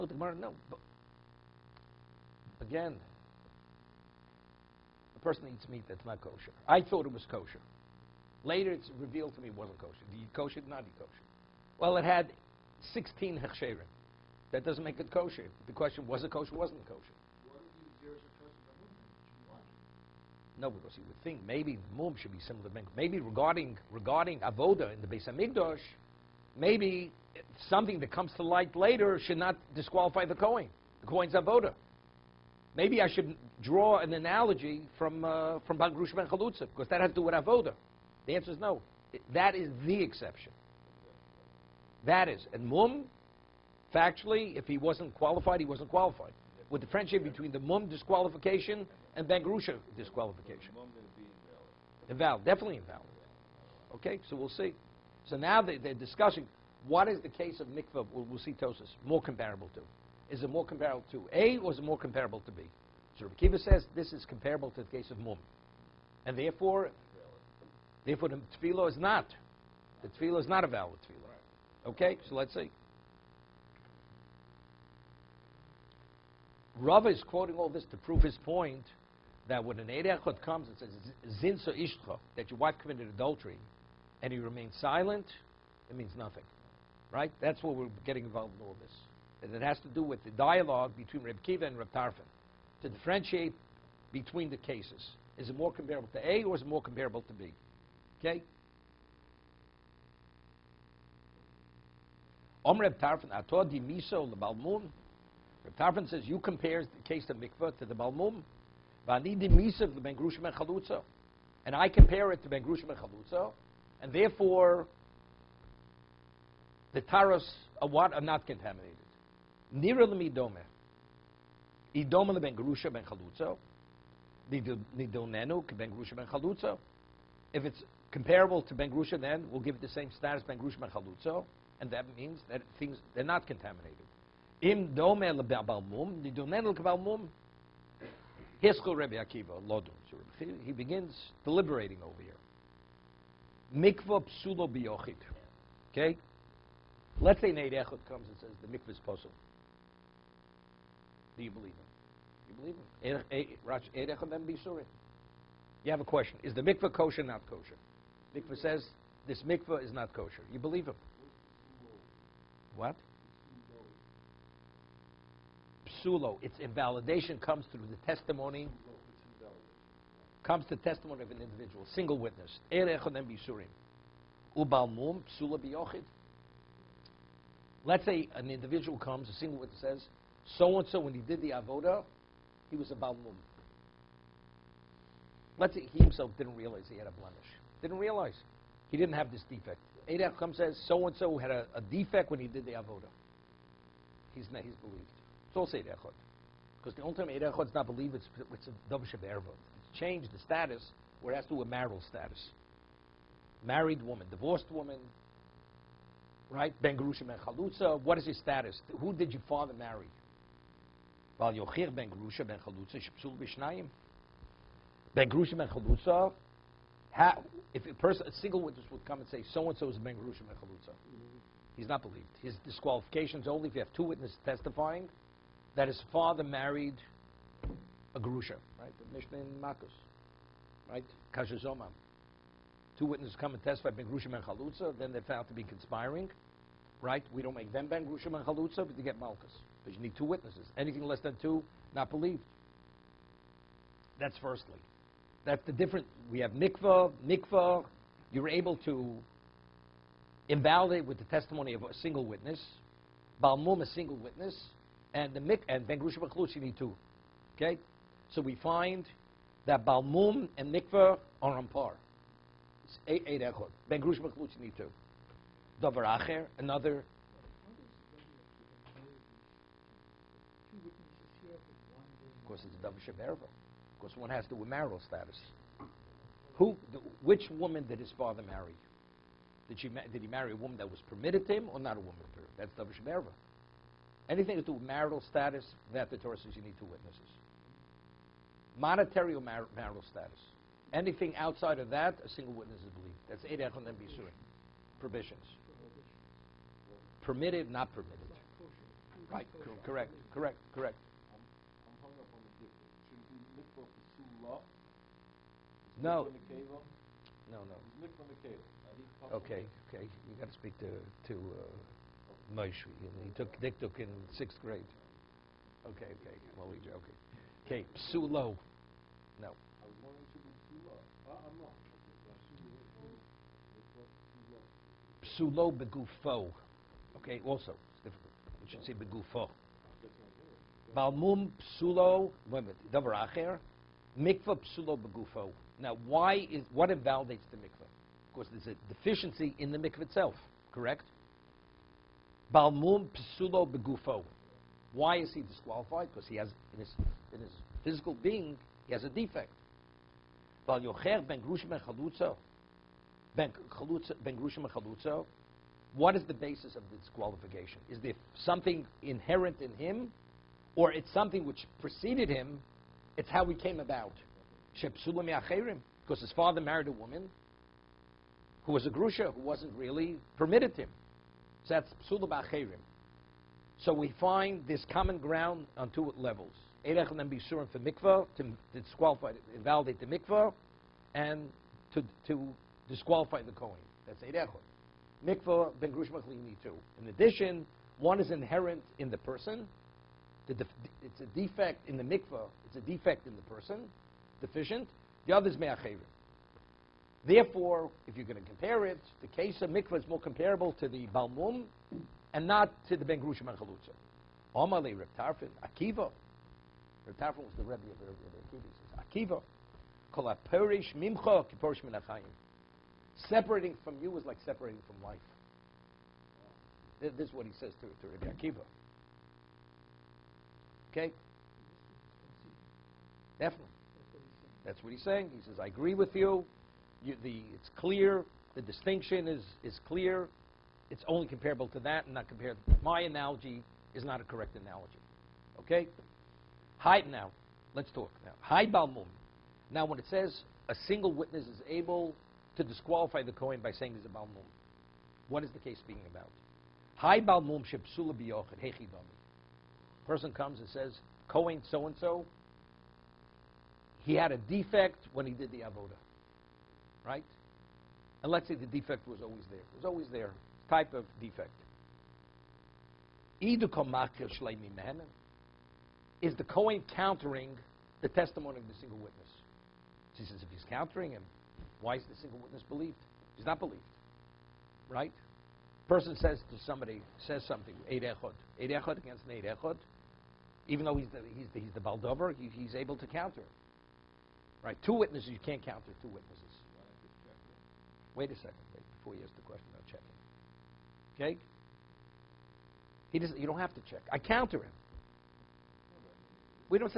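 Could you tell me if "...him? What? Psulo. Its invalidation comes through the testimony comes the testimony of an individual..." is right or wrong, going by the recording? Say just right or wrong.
right.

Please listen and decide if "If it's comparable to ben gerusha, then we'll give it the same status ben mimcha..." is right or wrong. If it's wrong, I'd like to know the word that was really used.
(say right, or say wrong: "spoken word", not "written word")
wrong: "gerusha", not "mimcha".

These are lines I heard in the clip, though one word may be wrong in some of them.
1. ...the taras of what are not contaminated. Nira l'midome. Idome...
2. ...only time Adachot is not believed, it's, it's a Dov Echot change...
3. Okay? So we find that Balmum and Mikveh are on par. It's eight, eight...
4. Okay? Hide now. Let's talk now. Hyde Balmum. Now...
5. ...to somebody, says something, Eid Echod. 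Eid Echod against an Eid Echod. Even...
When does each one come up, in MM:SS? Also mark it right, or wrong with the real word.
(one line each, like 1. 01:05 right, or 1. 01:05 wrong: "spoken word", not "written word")
1. 01:56 right
2. 03:17 wrong: "Shebervot", not "Echot"
3. 04:17 right
4. 07:15 right
5. 07:56 right.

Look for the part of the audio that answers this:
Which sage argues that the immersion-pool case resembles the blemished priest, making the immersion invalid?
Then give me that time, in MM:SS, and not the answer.
01:03.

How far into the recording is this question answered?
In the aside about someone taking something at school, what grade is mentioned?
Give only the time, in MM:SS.
05:14.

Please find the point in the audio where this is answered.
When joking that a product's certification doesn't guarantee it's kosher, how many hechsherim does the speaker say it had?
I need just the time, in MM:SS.
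00:12.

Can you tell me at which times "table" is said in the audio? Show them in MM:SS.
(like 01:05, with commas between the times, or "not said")
not said.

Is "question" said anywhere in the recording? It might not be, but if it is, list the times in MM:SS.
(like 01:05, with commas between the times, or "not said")
00:15, 02:36, 08:09.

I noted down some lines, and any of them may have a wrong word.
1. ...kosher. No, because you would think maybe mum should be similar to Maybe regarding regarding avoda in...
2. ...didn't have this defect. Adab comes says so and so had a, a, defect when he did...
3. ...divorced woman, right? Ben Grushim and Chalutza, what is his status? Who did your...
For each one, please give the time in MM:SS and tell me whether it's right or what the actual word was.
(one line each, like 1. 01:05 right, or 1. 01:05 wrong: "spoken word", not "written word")
1. 00:16 right
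2. 03:08 right
3. 03:24 right.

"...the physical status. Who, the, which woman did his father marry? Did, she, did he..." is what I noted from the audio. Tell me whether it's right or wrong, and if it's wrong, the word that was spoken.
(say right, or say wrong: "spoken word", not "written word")
wrong: "marital", not "physical".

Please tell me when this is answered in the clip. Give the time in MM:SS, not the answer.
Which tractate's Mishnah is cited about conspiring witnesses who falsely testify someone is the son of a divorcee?
03:48.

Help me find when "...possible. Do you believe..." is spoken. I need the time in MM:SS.
02:29.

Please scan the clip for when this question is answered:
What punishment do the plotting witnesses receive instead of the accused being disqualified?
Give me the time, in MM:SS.
03:59.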